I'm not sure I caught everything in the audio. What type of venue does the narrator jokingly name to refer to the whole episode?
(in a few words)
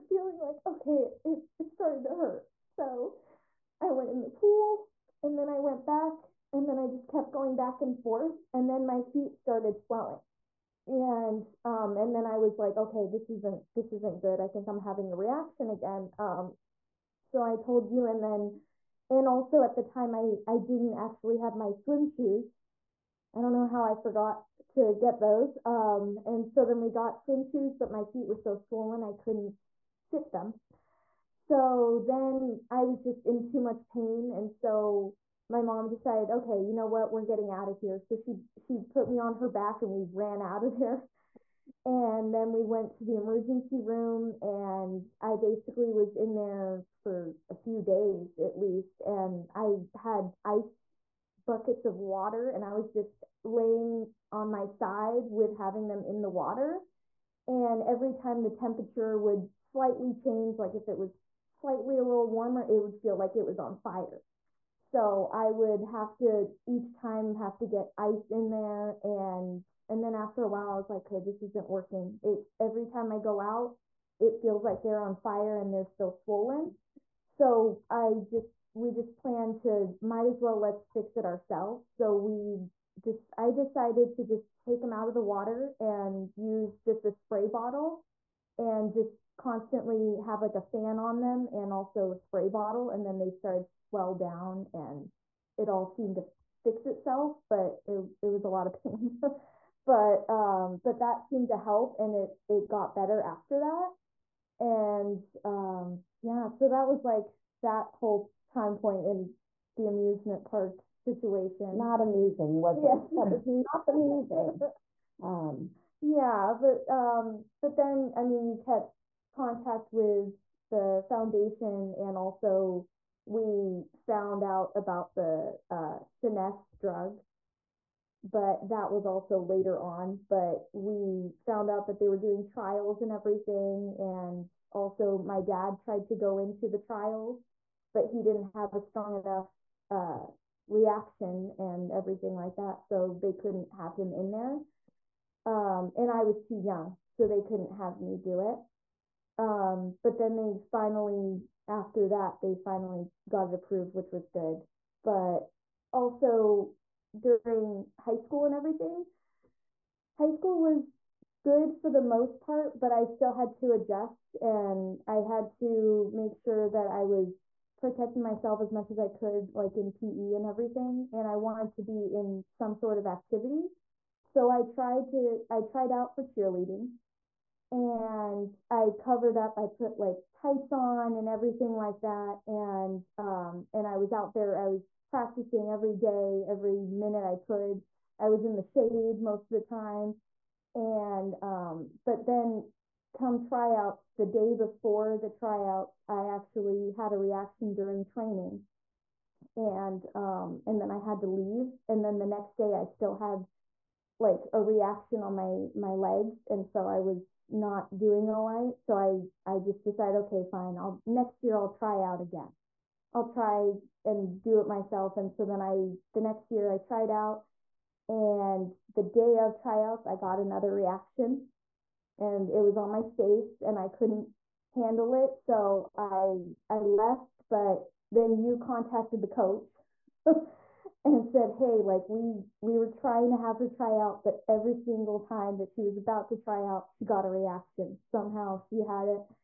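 amusement park.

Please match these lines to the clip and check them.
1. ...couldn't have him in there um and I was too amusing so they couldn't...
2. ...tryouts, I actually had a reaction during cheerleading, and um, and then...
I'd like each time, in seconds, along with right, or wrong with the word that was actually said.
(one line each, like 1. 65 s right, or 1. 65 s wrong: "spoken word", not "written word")
1. 143 s wrong: "young", not "amusing"
2. 195 s wrong: "training", not "cheerleading".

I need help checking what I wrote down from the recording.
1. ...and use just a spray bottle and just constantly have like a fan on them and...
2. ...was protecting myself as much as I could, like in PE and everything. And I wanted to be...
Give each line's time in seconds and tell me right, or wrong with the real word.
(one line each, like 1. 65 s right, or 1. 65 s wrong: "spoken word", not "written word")
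1. 85 s right
2. 167 s right.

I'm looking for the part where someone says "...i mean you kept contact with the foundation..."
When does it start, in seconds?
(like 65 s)
118 s.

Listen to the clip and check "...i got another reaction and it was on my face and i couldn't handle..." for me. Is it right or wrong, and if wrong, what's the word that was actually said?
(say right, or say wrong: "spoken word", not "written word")
right.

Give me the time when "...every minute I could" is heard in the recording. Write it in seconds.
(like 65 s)
186 s.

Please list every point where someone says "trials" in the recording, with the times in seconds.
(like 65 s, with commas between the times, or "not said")
132 s, 136 s.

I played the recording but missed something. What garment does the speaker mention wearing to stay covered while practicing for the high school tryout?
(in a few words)
tights.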